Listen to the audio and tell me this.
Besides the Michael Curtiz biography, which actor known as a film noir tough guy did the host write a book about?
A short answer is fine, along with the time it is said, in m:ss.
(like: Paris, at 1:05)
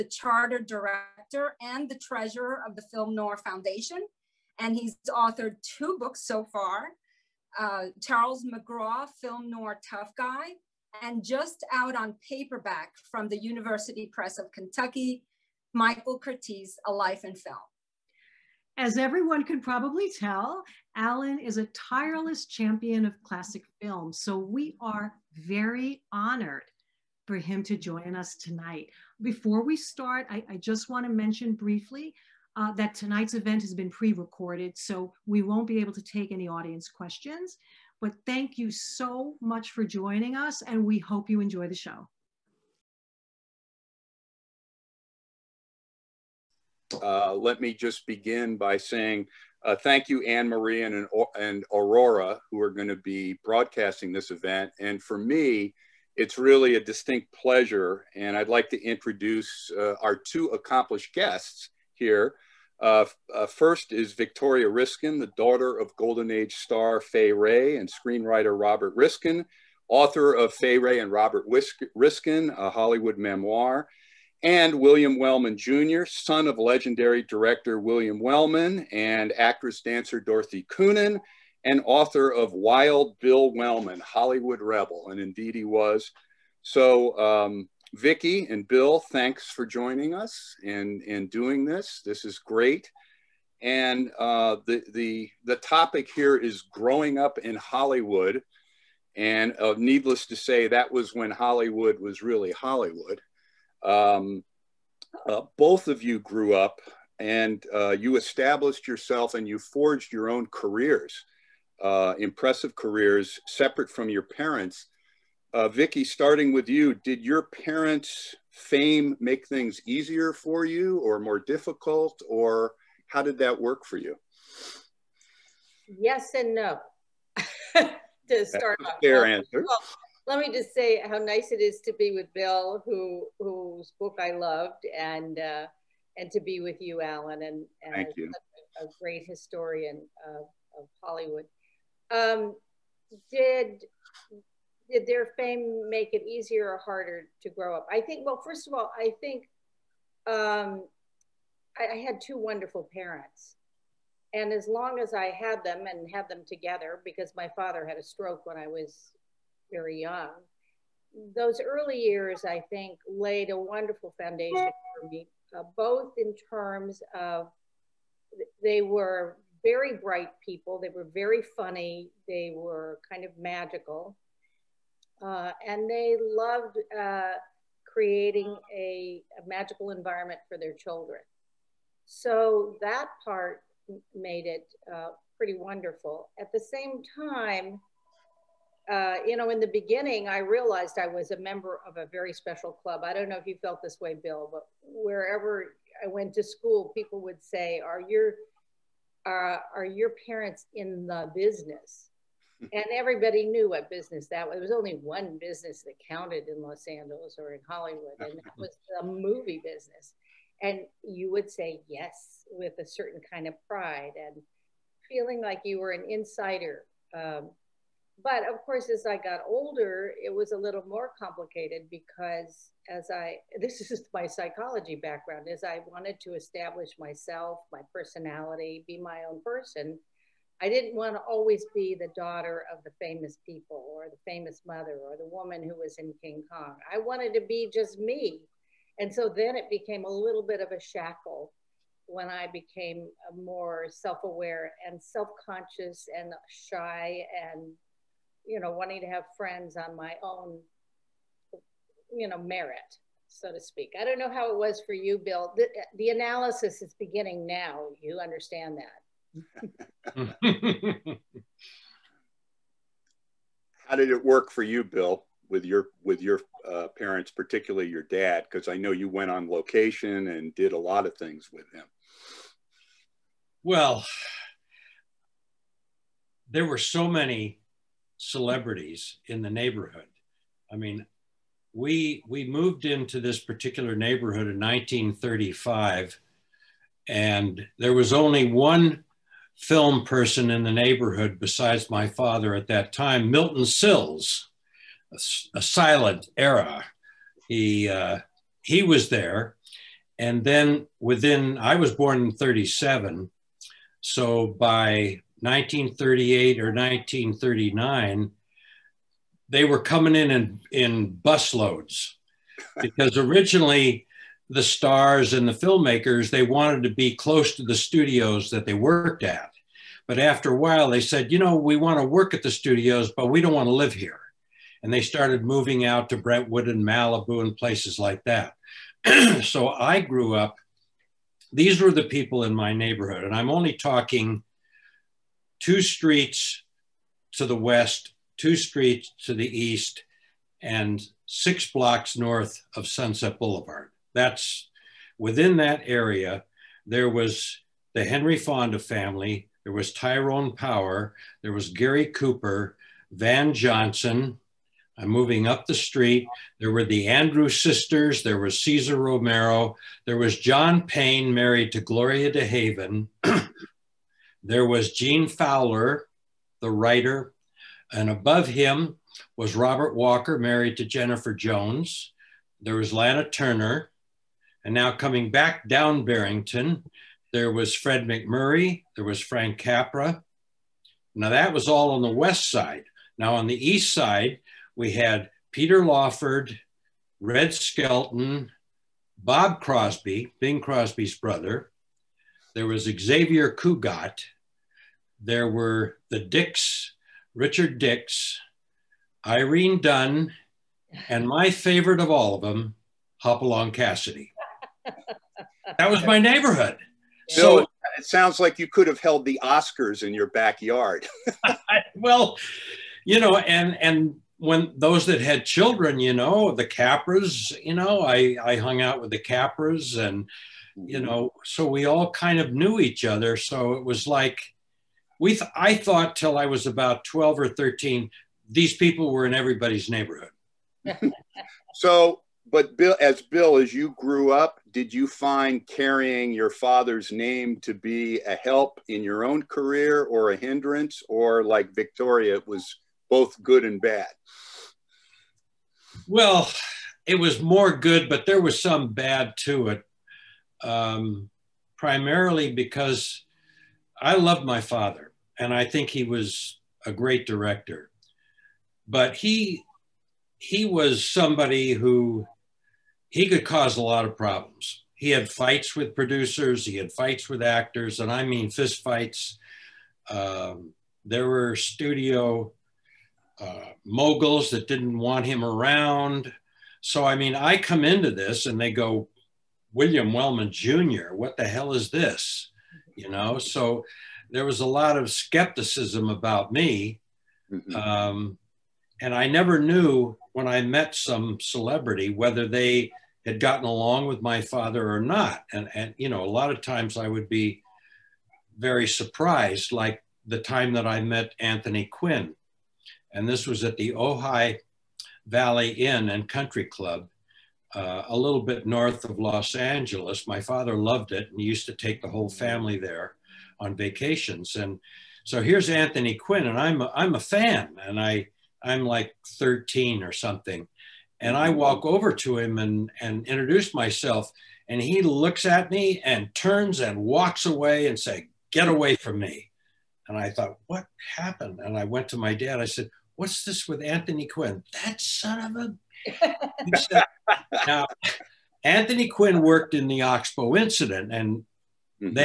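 Charles McGraw, at 0:08.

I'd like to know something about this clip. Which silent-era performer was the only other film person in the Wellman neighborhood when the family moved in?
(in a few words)
Milton Sills.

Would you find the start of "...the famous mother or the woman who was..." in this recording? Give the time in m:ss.
3:54.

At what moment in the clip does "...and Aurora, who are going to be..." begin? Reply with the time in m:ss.
0:51.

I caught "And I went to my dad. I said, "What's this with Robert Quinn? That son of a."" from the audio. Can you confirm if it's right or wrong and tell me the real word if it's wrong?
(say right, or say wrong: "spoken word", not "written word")
wrong: "Anthony", not "Robert".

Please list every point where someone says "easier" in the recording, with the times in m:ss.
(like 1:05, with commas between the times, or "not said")
1:59, 2:26.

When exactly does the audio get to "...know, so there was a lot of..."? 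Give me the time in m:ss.
8:03.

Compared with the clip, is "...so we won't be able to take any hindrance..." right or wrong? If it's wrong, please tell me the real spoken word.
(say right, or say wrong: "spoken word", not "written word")
wrong: "audience", not "hindrance".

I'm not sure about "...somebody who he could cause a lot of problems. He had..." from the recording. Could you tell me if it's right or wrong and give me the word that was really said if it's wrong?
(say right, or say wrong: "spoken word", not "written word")
right.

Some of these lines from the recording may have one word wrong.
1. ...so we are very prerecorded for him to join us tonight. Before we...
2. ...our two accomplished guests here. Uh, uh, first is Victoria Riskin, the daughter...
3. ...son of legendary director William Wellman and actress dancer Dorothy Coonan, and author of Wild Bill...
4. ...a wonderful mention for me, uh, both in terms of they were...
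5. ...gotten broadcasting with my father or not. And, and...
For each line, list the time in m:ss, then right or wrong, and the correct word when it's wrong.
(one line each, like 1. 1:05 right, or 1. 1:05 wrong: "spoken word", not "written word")
1. 0:24 wrong: "honored", not "prerecorded"
2. 1:00 right
3. 1:16 right
4. 2:43 wrong: "foundation", not "mention"
5. 8:13 wrong: "along", not "broadcasting".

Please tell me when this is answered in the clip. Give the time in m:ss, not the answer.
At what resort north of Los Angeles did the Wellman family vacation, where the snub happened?
8:23.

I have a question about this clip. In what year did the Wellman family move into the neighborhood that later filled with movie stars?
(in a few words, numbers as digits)
1935.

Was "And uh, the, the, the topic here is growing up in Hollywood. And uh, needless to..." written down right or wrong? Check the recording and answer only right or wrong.
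right.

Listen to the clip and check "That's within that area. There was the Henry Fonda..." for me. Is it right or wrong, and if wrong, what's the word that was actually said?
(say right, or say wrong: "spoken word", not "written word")
right.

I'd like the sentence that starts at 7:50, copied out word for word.
Um, there were studio uh, moguls that didn't want him around.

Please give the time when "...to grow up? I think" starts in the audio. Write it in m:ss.
2:27.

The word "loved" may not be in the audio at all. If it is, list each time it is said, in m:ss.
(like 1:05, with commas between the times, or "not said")
2:14, 2:56, 7:34, 8:30.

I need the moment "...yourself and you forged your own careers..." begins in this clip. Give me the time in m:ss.
1:48.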